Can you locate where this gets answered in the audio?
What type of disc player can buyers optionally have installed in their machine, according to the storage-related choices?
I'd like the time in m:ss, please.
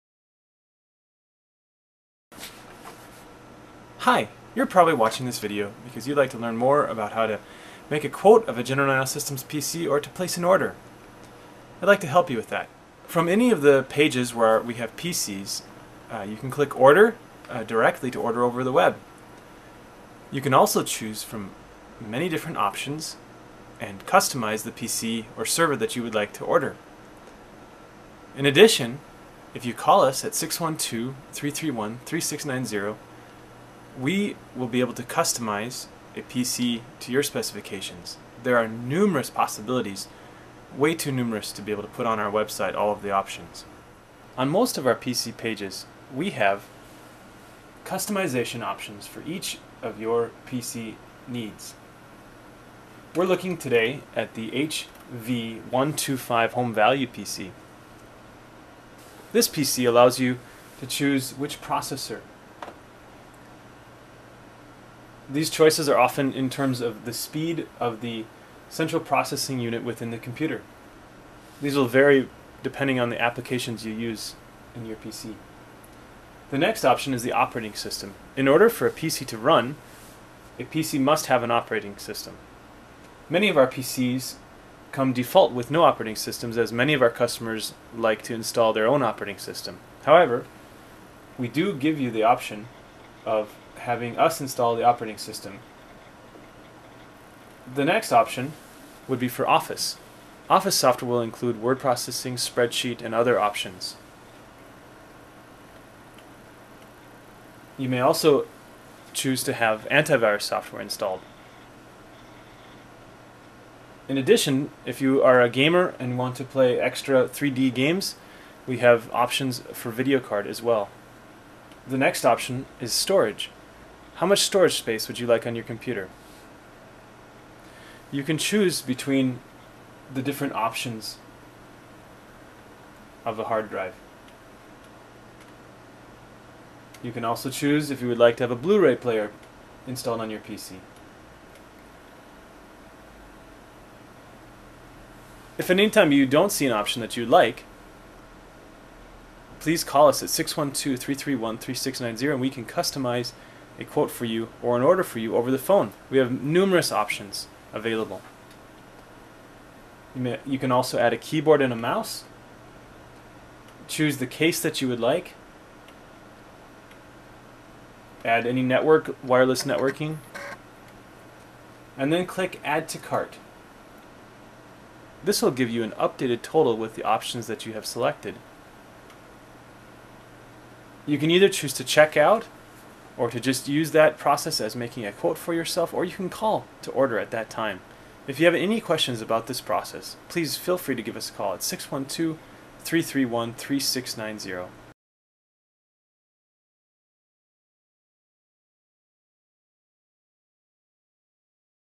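2:18.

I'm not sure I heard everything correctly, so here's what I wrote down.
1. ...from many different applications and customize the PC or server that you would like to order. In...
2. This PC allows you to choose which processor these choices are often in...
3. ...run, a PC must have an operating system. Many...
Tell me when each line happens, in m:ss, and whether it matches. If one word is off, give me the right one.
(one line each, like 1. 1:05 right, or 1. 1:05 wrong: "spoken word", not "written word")
1. 0:21 wrong: "options", not "applications"
2. 0:59 right
3. 1:19 right.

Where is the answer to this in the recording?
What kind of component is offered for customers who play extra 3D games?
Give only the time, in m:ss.
1:59.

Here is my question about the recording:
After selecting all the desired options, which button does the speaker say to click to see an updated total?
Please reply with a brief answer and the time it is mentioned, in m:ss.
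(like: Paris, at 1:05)
Add to Cart, at 2:52.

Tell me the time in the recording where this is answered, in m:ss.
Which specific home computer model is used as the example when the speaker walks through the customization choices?
0:55.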